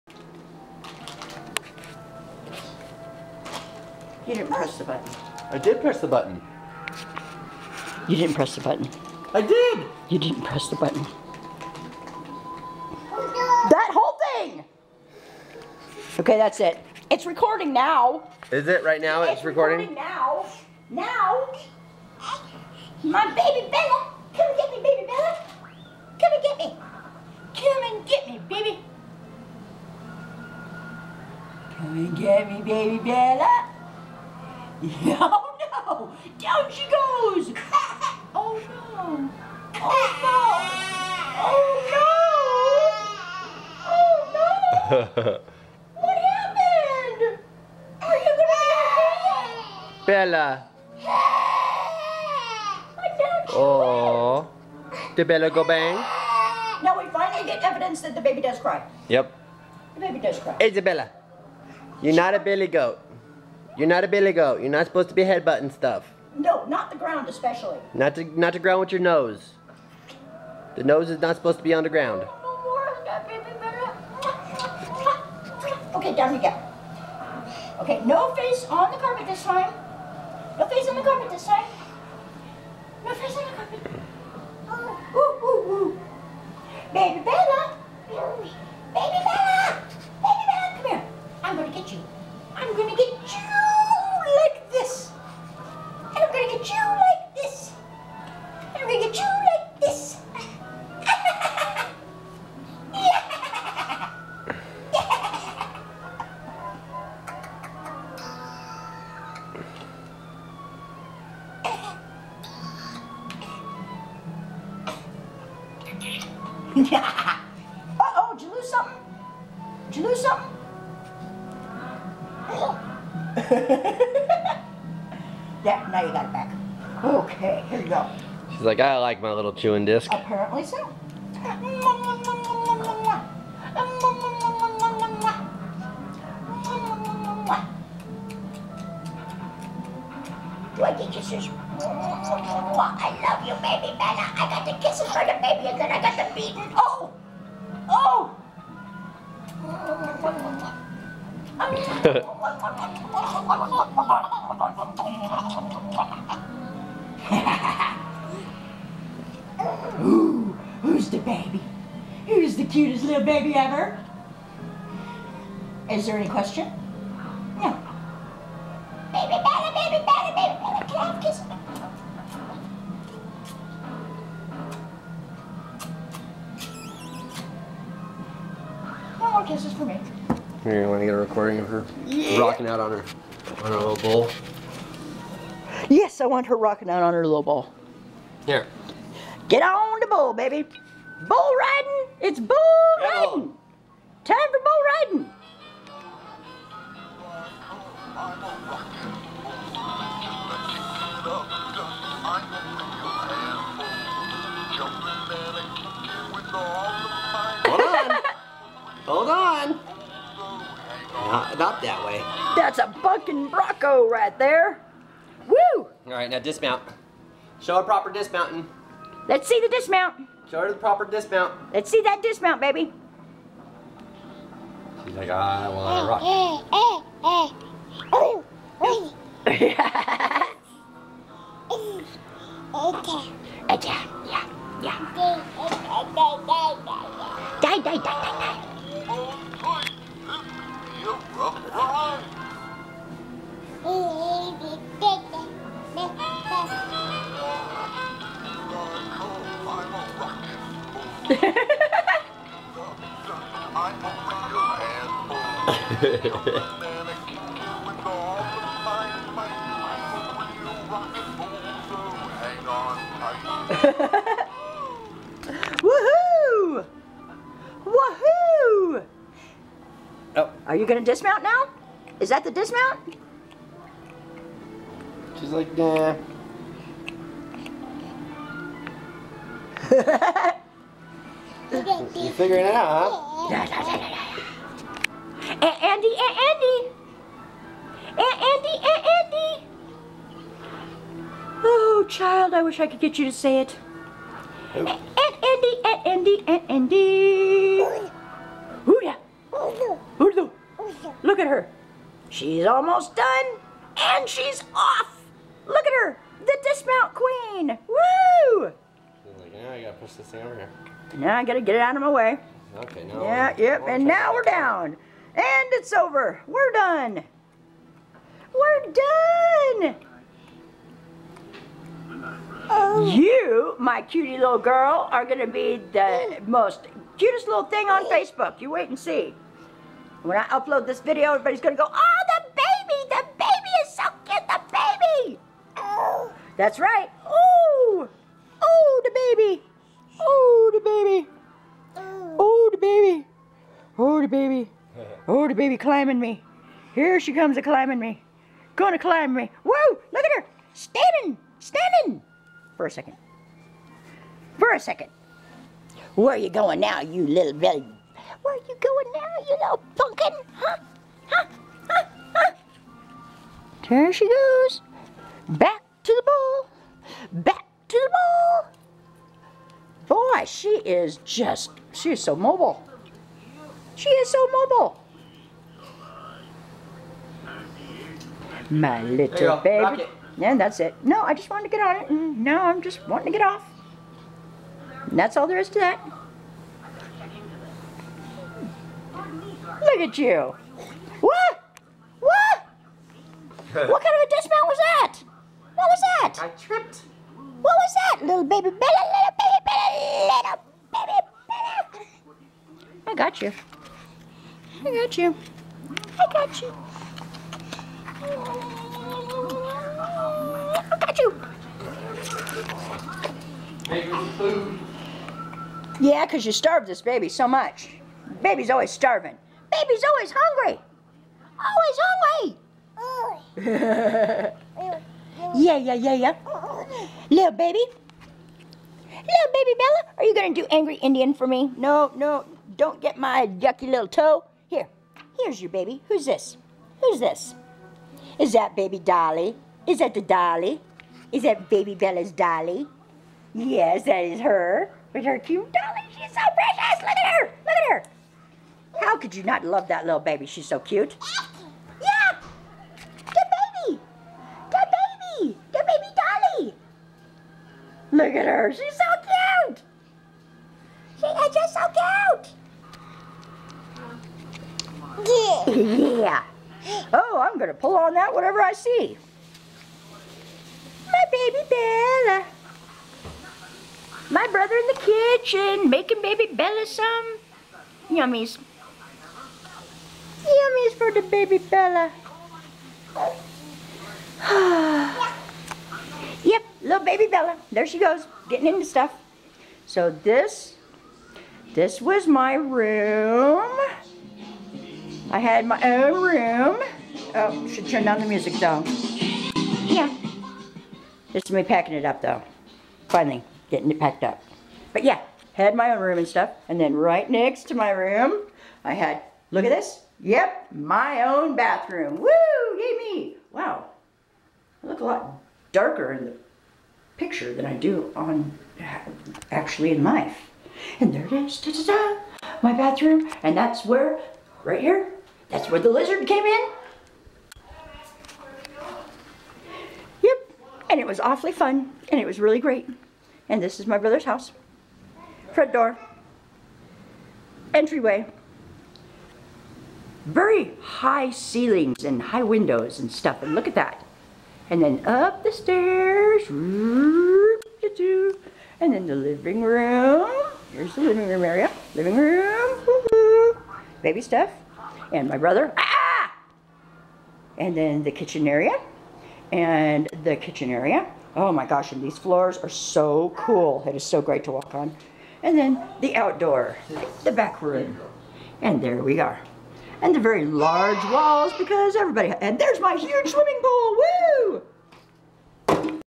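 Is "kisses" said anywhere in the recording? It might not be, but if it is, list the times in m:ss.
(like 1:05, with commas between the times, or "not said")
2:24, 2:51.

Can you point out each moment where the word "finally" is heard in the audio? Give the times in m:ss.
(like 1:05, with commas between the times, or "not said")
0:57, 8:23.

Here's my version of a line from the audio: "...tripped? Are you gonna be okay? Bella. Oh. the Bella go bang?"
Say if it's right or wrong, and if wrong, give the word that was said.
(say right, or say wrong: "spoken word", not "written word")
wrong: "happened", not "tripped".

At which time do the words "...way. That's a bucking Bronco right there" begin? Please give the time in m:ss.
3:32.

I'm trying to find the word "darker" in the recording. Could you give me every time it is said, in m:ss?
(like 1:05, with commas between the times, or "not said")
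8:35.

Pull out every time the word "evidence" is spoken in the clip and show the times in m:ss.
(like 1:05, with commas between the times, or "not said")
0:57.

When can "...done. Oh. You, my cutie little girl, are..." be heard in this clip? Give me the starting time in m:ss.
5:18.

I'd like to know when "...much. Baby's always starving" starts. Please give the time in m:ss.
6:57.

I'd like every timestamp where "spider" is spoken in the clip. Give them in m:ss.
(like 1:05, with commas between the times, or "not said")
not said.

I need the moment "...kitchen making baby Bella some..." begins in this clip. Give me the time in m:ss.
7:55.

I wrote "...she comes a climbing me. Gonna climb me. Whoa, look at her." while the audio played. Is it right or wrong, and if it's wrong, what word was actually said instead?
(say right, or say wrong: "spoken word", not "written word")
right.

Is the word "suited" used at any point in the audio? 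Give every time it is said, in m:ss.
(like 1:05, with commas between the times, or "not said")
not said.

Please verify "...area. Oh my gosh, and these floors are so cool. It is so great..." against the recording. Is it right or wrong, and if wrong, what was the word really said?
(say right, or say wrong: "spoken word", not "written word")
right.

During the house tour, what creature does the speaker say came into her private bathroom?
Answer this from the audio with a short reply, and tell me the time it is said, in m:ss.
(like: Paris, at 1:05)
lizard, at 8:45.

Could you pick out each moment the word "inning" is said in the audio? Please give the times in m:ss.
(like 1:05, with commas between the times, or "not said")
not said.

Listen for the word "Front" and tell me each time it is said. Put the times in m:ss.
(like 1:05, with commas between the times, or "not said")
8:55.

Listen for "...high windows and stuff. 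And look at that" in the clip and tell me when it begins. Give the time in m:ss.
9:02.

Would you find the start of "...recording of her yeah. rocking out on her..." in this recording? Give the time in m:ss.
3:01.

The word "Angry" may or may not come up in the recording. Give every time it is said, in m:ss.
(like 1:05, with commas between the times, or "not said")
7:10.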